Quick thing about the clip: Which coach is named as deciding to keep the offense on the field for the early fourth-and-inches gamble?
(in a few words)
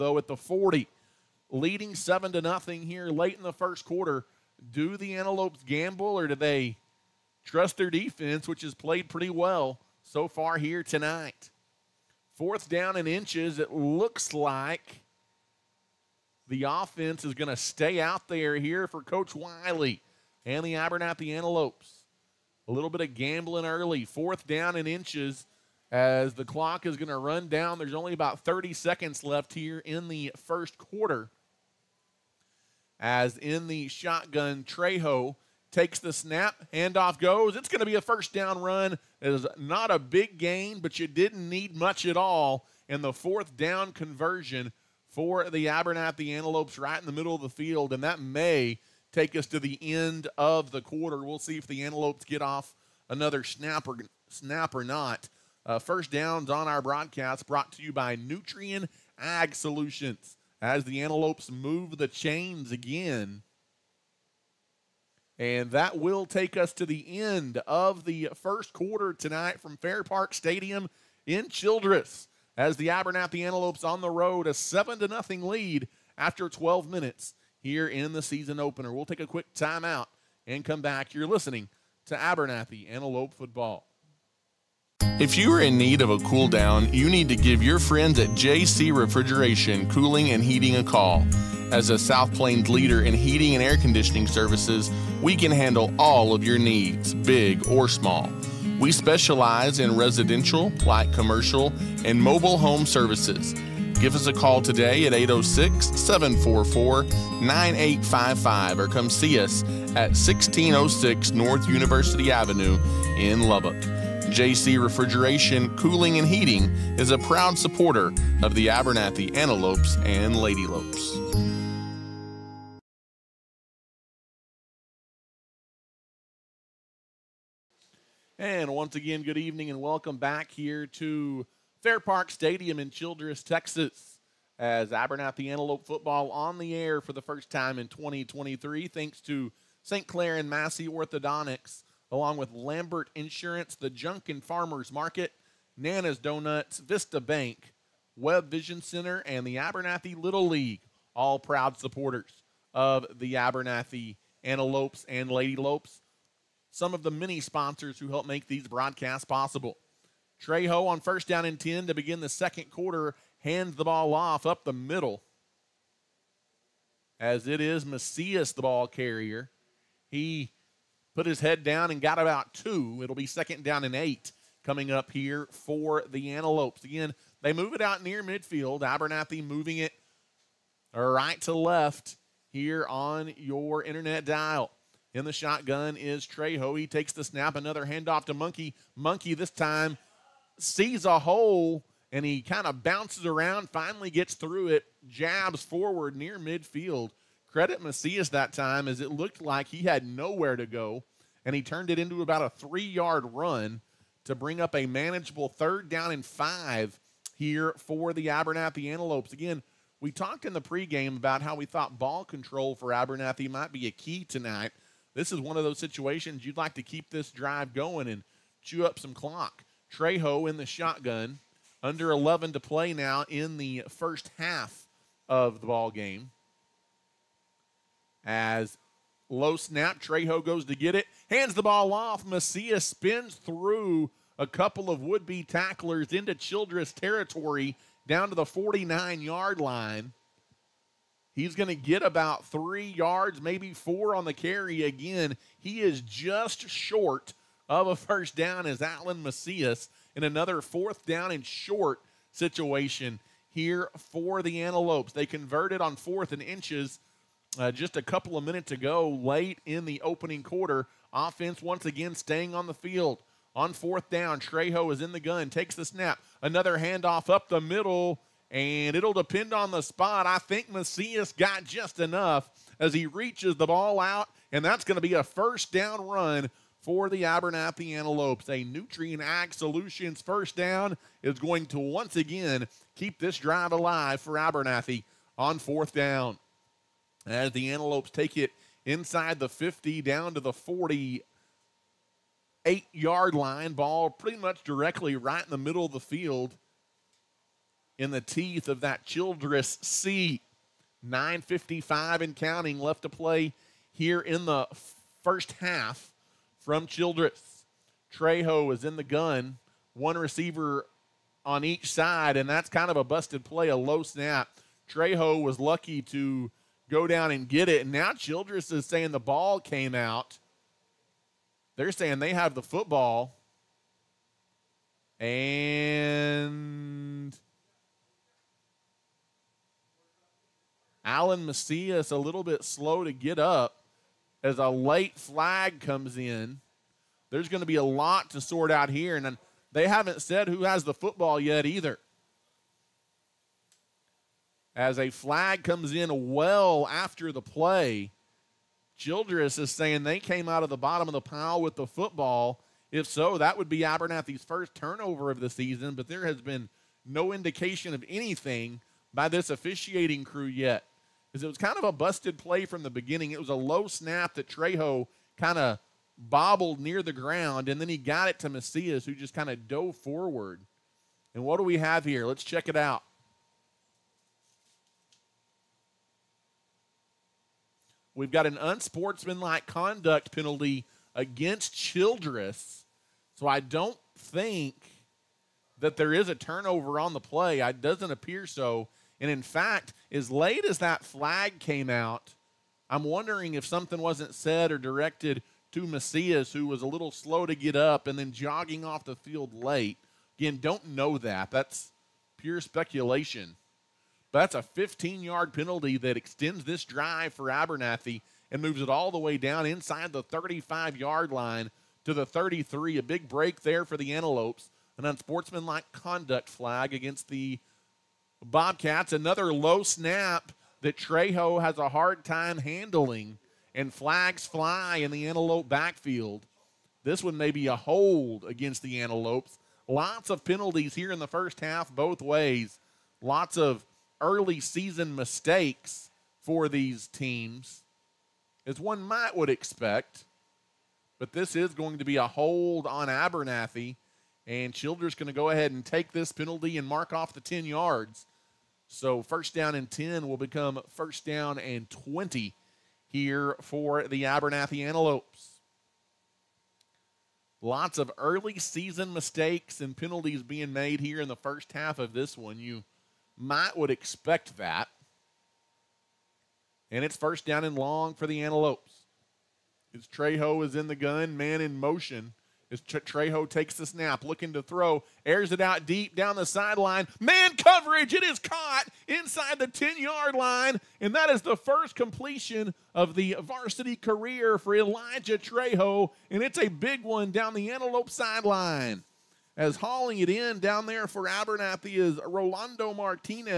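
Coach Wiley.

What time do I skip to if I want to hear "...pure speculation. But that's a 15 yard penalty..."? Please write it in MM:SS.
06:42.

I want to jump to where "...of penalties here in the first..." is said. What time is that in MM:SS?
07:10.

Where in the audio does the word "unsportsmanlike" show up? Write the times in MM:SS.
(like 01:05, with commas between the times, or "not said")
06:18, 06:55.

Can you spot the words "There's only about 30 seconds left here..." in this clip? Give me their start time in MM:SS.
00:27.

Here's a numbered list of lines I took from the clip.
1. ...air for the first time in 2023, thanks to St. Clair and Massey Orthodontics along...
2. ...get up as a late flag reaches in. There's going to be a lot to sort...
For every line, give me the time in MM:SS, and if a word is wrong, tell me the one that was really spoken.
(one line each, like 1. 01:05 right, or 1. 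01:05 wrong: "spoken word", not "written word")
1. 02:16 right
2. 05:33 wrong: "comes", not "reaches".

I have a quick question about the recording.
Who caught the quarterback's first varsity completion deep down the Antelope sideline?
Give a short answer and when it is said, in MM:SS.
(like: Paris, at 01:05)
Rolando Martinez, at 08:12.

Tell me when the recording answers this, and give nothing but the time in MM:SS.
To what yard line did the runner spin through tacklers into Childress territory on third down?
03:58.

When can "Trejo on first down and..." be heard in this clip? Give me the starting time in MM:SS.
02:40.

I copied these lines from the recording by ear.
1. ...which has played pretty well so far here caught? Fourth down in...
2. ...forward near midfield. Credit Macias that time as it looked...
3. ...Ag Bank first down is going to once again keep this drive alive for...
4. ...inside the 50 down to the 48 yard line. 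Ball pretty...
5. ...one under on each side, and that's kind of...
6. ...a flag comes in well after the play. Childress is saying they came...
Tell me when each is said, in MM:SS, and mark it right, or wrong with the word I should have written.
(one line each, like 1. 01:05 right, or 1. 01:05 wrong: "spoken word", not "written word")
1. 00:08 wrong: "tonight", not "caught"
2. 03:15 right
3. 04:39 wrong: "Solutions", not "Bank"
4. 04:48 right
5. 05:09 wrong: "receiver", not "under"
6. 05:44 right.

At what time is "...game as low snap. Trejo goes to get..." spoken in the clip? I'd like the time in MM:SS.
03:45.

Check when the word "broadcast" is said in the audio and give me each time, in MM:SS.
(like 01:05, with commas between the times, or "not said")
00:56, 02:38.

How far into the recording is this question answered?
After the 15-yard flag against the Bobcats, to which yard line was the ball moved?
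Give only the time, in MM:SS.
06:52.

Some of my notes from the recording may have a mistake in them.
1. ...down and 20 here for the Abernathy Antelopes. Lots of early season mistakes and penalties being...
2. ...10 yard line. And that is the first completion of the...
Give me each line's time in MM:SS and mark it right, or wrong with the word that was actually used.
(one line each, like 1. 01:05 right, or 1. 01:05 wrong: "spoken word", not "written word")
1. 07:31 right
2. 07:59 right.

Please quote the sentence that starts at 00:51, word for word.
We'll see if the Antelopes get off another snap or, snap or not.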